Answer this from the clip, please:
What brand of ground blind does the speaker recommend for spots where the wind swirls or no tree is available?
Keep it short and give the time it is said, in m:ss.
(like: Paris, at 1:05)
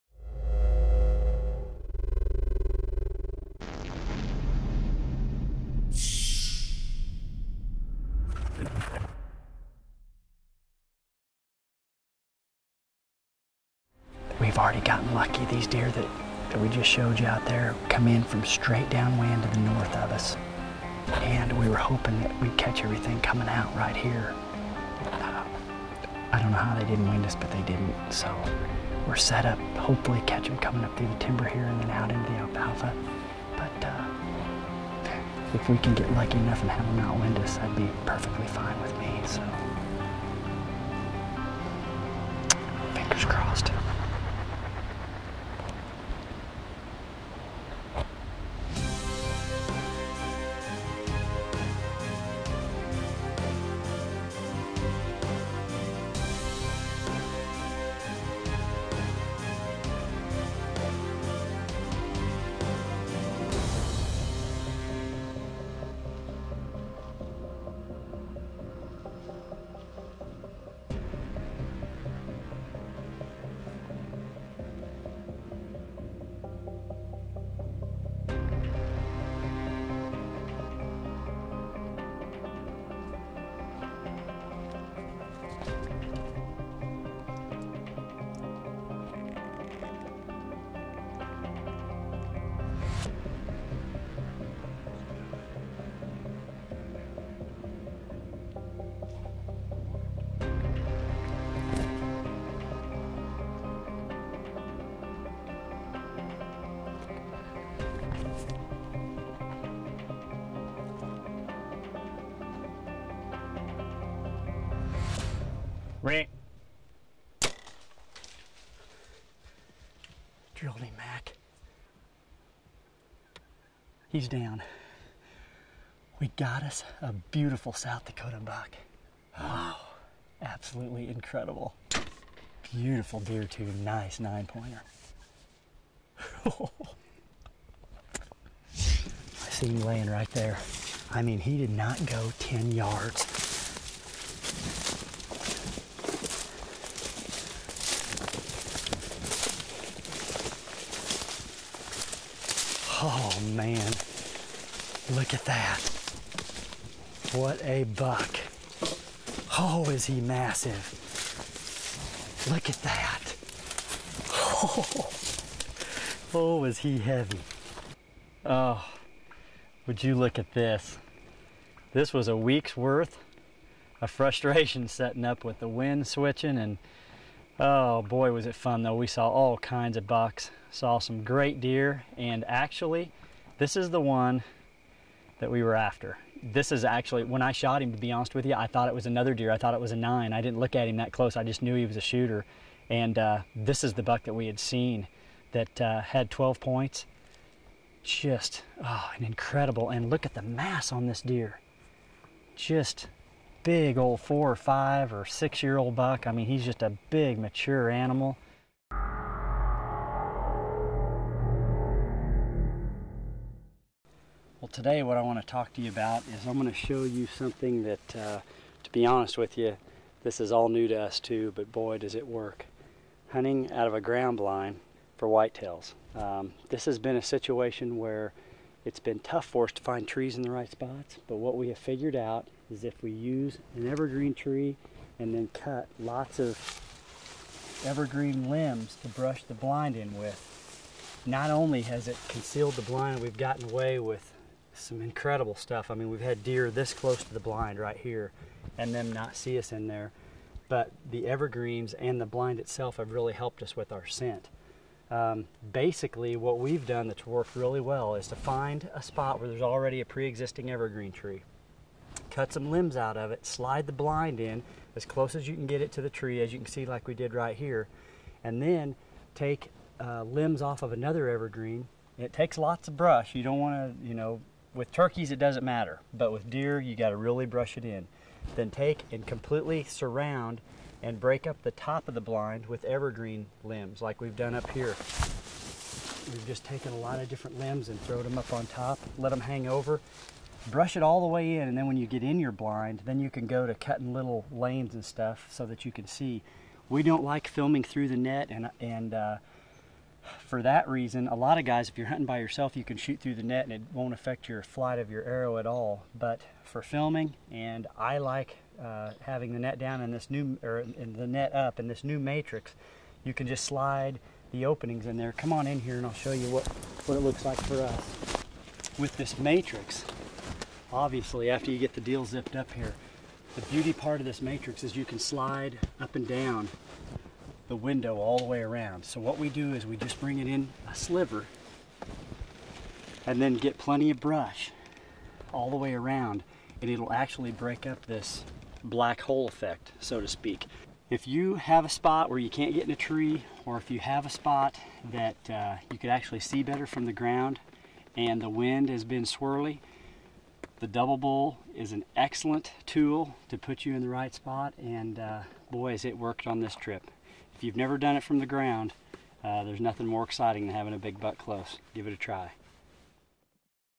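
Double Bull, at 5:50.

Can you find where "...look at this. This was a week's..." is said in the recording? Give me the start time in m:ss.
2:50.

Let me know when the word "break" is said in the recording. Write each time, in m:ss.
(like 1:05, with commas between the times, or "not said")
4:41, 5:37.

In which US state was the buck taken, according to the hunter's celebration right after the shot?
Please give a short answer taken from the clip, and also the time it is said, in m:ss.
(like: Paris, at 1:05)
South Dakota, at 2:07.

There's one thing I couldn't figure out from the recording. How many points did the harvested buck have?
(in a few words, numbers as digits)
12.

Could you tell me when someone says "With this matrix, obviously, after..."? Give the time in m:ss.
5:18.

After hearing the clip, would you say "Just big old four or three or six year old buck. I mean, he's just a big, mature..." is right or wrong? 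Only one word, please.
wrong.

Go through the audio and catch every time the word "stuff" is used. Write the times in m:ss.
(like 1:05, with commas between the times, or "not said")
4:05, 4:55.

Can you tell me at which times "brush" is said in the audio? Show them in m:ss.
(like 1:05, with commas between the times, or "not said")
3:59, 4:32, 4:37, 4:50, 5:34.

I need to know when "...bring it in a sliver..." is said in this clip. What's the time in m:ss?
5:30.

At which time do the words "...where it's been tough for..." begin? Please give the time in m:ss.
3:47.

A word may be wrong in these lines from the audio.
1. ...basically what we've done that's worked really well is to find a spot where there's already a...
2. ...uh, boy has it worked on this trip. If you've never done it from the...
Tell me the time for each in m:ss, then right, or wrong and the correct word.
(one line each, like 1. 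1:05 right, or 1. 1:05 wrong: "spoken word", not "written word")
1. 4:15 right
2. 5:55 right.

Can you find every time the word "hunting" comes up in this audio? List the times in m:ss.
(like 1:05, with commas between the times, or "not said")
3:43, 5:02.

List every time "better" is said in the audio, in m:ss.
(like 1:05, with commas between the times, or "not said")
5:46.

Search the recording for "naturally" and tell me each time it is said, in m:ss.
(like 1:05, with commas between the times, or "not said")
not said.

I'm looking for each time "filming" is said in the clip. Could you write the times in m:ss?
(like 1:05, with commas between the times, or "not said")
4:57, 5:06.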